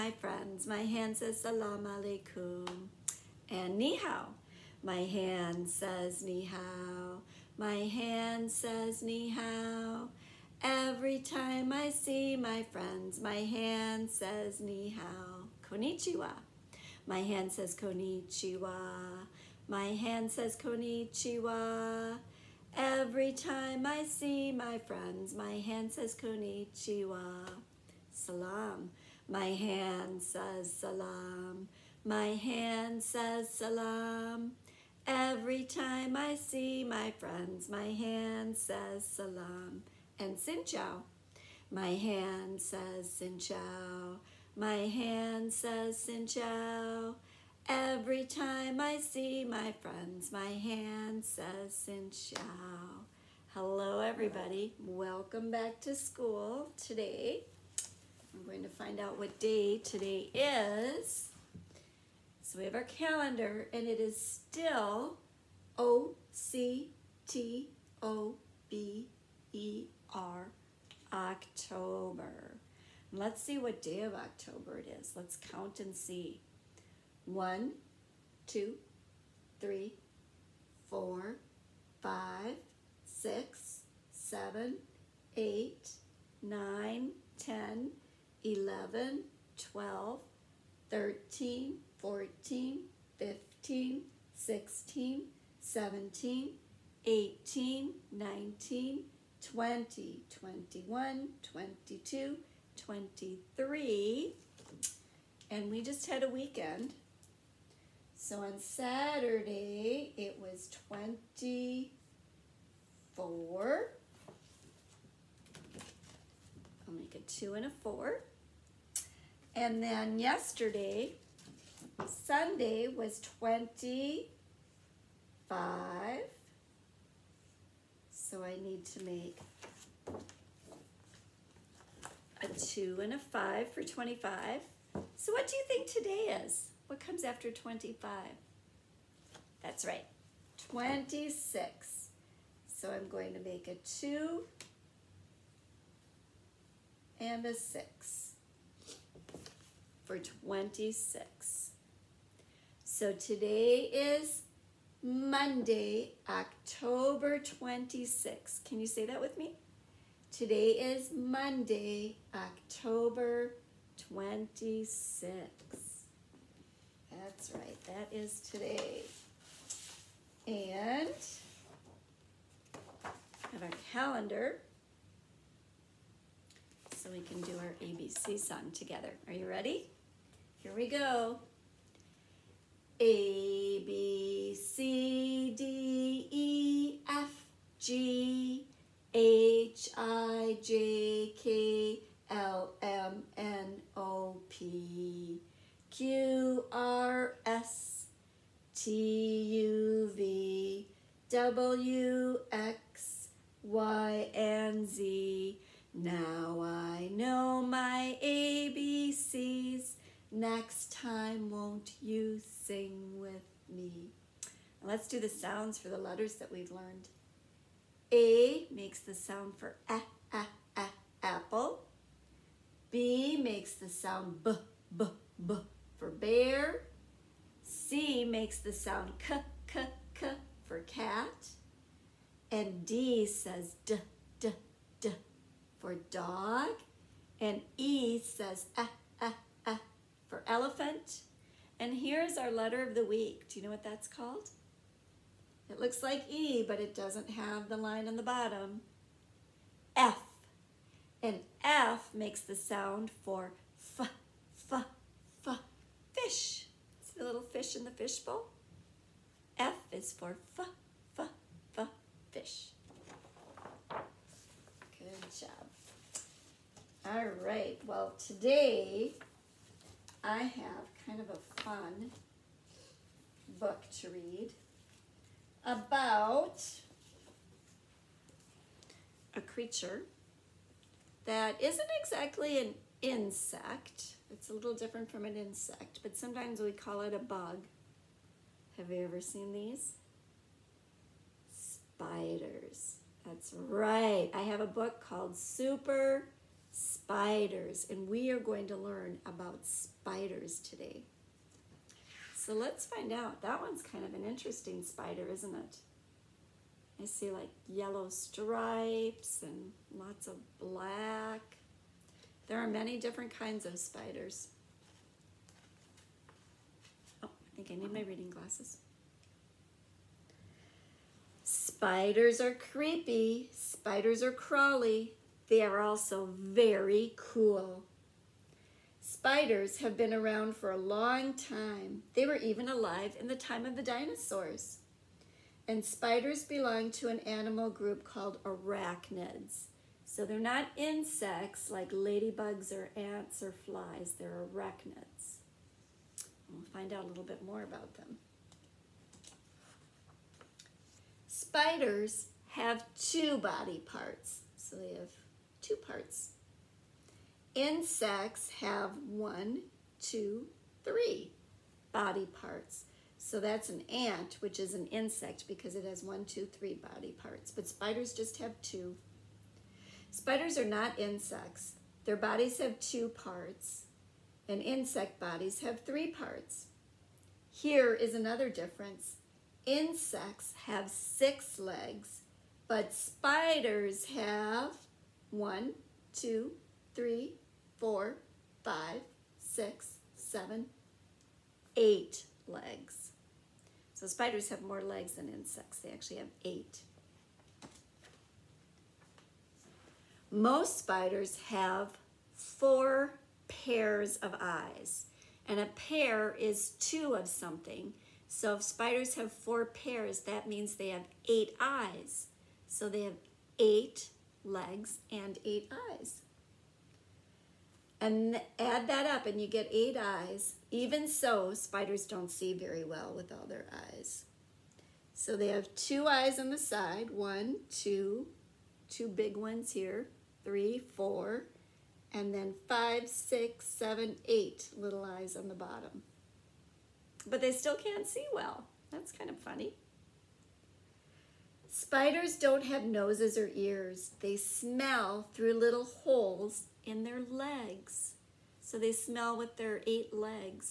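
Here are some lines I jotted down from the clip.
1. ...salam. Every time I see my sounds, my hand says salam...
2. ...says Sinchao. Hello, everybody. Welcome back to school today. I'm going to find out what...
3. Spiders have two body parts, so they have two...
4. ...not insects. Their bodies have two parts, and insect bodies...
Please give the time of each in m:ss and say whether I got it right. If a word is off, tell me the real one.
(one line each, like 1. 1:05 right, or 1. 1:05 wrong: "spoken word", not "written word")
1. 0:33 wrong: "friends", not "sounds"
2. 0:51 right
3. 5:51 right
4. 6:10 right.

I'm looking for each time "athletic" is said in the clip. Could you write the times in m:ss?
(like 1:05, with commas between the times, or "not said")
not said.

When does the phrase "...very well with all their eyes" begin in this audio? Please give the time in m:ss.
7:02.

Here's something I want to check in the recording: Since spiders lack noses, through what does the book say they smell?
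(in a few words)
Little holes in their legs.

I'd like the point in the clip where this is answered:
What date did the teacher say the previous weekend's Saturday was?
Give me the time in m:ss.
1:50.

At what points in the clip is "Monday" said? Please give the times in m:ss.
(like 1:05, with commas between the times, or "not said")
2:35, 2:41.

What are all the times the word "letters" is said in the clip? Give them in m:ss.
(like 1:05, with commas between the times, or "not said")
3:35, 4:02.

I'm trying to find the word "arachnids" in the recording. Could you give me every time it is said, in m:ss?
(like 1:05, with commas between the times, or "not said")
5:38, 5:44.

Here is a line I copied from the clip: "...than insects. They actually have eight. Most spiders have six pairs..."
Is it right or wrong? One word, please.
wrong.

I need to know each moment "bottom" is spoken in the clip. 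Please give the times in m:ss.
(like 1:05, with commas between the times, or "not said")
4:08, 7:15.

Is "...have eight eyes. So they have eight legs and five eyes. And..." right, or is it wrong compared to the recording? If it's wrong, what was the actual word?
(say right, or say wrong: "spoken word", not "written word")
wrong: "eight", not "five".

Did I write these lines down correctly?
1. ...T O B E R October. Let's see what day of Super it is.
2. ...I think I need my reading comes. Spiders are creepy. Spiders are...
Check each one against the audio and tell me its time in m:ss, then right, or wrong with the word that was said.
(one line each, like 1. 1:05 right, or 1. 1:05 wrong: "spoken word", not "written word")
1. 1:07 wrong: "October", not "Super"
2. 5:17 wrong: "glasses", not "comes".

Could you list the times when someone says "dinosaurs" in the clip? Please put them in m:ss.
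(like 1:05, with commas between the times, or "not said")
5:33.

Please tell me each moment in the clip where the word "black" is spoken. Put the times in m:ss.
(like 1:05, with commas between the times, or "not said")
5:10.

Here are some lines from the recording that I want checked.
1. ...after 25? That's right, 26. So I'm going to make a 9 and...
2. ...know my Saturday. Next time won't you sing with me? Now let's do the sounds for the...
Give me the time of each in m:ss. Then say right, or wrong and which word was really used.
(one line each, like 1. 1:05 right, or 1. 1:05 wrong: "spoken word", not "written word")
1. 2:17 wrong: "2", not "9"
2. 3:27 wrong: "ABCs", not "Saturday".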